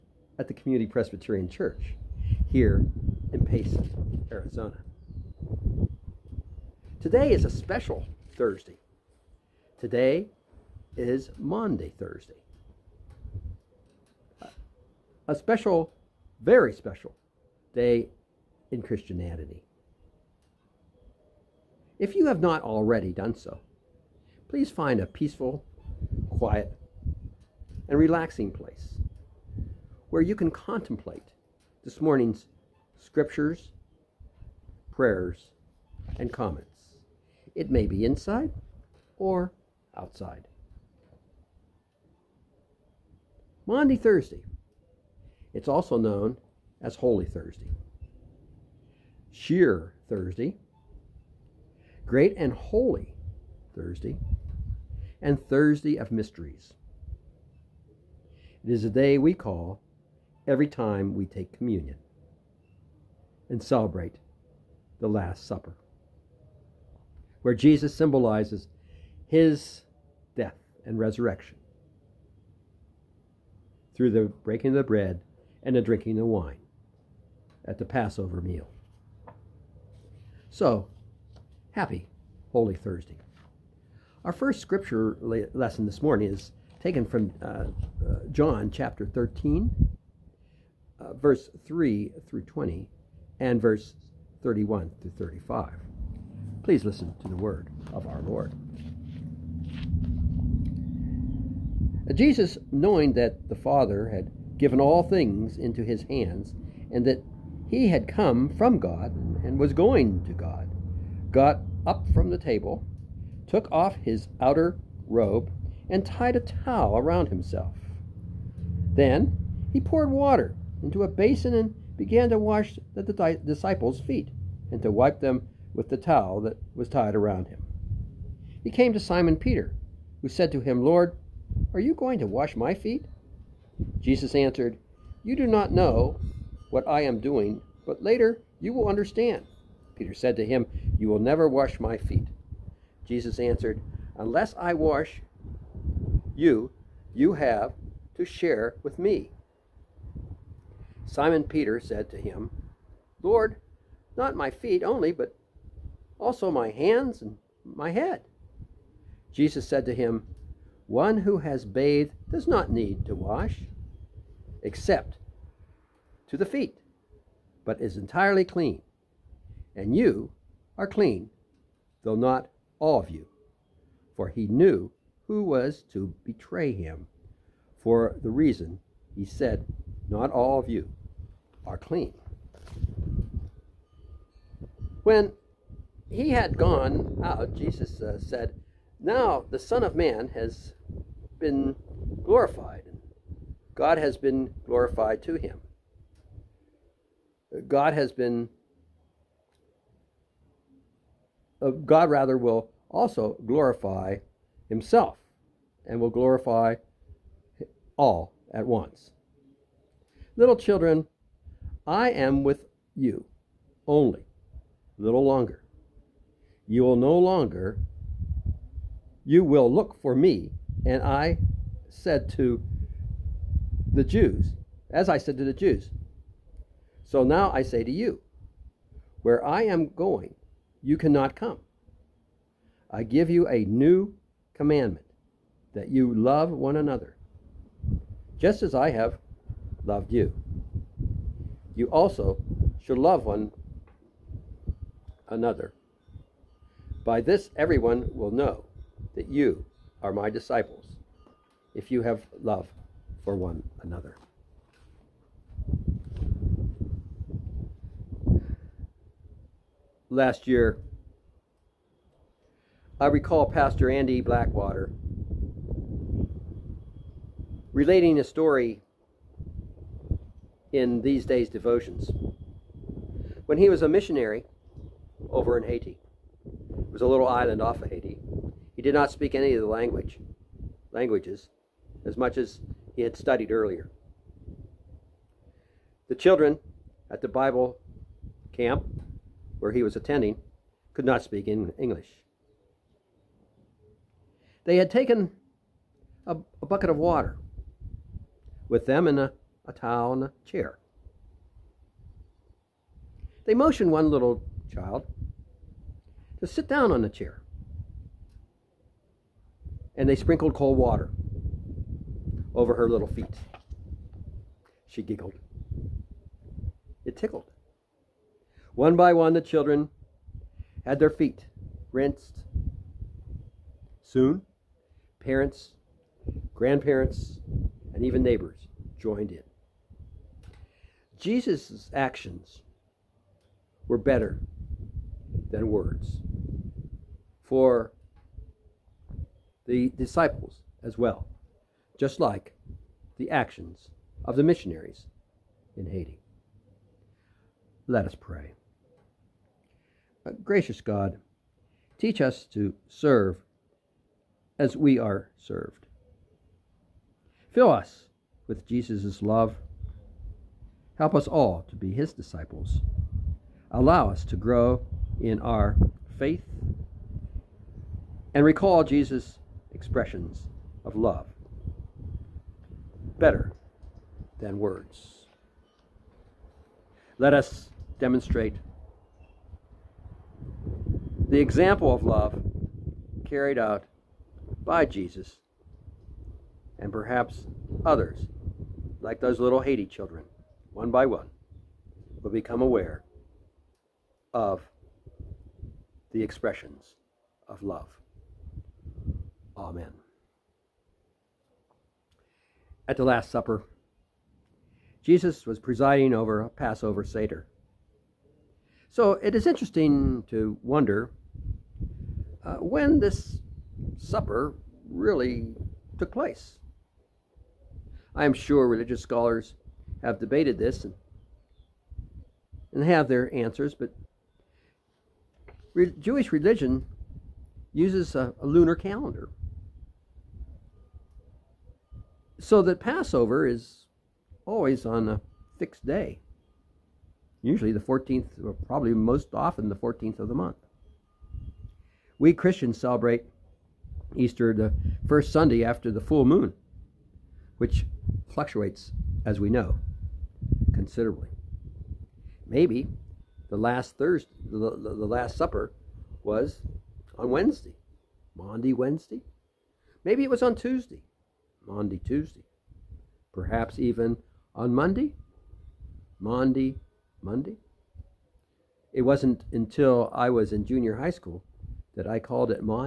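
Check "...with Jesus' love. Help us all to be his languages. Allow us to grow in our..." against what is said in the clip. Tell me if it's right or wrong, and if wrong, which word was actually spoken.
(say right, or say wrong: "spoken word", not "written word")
wrong: "disciples", not "languages".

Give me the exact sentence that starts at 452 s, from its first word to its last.
Maybe the last Thursday, the, the, the Last Supper was on Wednesday, Maundy Wednesday.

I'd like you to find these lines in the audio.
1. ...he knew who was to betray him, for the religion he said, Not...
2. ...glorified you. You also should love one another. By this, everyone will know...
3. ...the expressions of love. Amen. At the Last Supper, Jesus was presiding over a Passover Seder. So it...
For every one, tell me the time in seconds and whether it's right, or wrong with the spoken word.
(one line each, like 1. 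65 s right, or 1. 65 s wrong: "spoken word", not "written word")
1. 174 s wrong: "reason", not "religion"
2. 239 s wrong: "loved", not "glorified"
3. 396 s right.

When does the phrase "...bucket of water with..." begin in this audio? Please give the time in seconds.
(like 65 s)
296 s.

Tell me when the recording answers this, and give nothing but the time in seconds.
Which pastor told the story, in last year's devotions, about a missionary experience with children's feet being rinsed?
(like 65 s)
263 s.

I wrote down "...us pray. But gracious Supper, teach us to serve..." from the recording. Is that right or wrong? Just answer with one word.
wrong.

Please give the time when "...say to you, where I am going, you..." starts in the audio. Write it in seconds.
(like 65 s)
227 s.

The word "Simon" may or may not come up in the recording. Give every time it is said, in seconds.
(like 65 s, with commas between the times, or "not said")
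129 s, 151 s.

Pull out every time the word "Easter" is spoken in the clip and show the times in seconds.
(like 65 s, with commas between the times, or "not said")
444 s.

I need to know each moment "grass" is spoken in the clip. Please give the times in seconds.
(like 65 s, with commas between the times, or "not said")
not said.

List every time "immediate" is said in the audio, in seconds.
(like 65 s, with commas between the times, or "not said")
not said.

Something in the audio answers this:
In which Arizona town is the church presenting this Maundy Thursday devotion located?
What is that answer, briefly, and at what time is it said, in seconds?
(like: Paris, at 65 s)
Payson, at 3 s.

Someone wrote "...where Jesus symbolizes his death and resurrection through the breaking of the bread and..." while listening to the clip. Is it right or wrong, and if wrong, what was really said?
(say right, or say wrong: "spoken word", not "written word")
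right.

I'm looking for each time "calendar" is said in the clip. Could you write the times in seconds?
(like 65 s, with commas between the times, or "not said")
428 s.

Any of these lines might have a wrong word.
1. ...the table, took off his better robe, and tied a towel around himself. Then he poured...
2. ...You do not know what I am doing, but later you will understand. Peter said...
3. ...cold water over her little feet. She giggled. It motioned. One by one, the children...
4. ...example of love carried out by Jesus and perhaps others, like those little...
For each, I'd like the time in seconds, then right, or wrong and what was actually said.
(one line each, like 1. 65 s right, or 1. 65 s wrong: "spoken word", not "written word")
1. 112 s wrong: "outer", not "better"
2. 135 s right
3. 310 s wrong: "tickled", not "motioned"
4. 381 s right.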